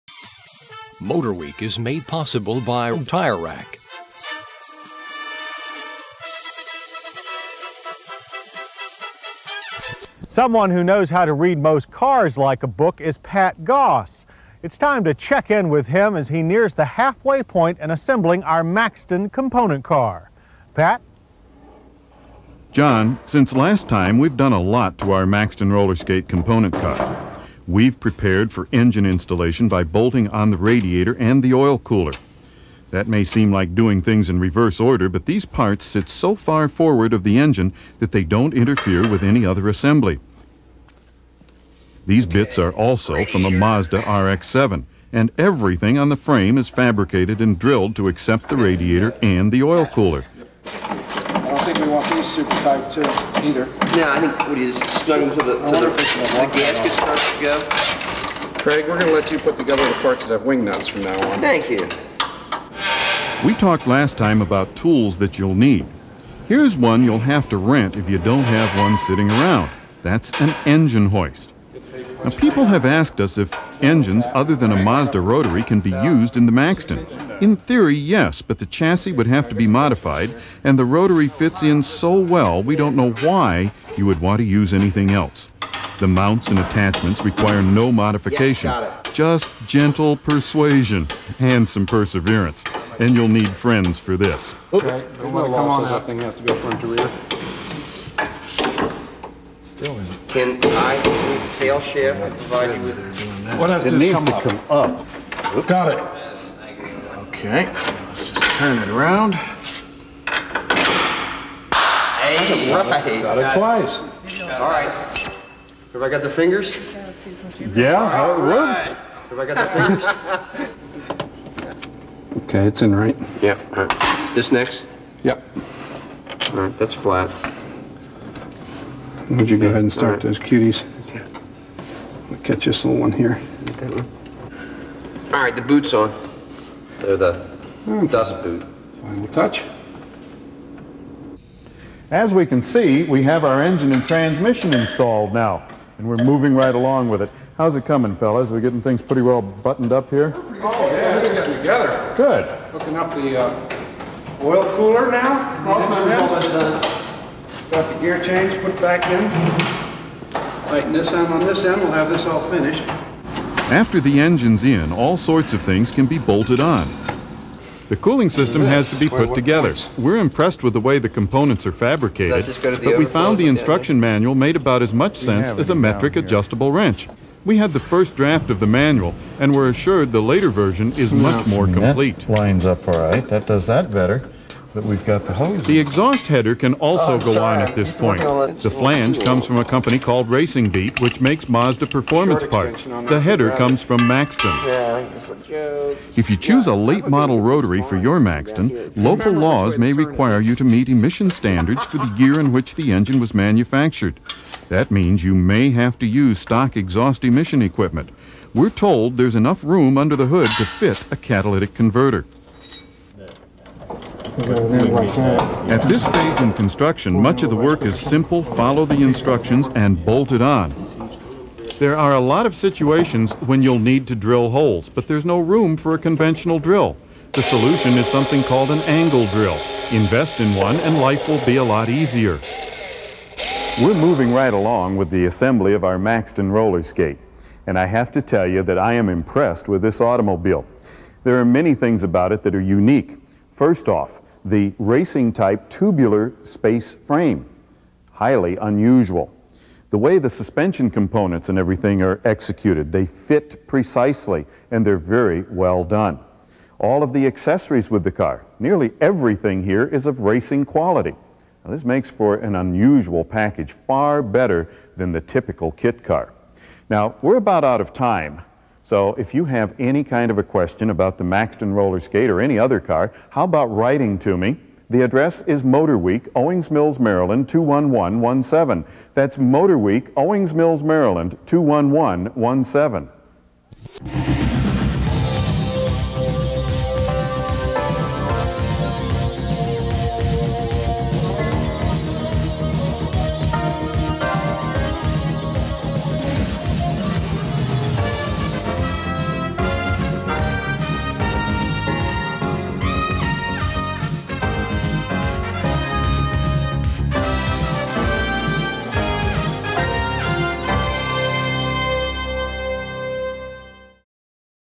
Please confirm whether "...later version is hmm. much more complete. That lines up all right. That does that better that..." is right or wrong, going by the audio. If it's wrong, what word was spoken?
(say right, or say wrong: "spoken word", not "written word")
right.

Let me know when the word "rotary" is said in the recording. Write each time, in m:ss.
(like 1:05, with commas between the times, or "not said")
1:15, 1:20, 3:17.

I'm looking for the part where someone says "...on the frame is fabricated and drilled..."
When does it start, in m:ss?
0:45.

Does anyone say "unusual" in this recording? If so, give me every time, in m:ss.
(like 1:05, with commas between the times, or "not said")
4:08, 4:22.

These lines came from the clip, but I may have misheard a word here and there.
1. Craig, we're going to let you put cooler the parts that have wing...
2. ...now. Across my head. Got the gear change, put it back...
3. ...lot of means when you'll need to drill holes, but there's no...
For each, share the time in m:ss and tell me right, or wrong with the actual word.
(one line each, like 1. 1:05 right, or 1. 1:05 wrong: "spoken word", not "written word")
1. 0:58 wrong: "together", not "cooler"
2. 2:35 right
3. 3:42 wrong: "situations", not "means".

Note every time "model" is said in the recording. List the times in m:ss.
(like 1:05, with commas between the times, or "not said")
3:17.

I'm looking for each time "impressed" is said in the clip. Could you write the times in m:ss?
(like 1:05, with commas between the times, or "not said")
2:50, 3:59.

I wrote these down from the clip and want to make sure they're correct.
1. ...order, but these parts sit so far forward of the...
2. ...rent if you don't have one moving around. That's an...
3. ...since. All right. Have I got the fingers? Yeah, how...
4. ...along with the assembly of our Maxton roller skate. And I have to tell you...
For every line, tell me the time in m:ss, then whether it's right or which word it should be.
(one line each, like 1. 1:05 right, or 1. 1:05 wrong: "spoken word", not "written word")
1. 0:34 right
2. 1:07 wrong: "sitting", not "moving"
3. 1:53 wrong: "twice", not "since"
4. 3:54 right.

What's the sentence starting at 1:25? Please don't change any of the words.
The mounts and attachments require no modification, yes, just gentle persuasion and some perseverance.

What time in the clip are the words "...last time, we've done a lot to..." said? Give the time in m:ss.
0:23.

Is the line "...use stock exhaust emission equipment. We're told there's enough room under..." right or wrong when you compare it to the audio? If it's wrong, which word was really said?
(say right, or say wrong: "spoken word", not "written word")
right.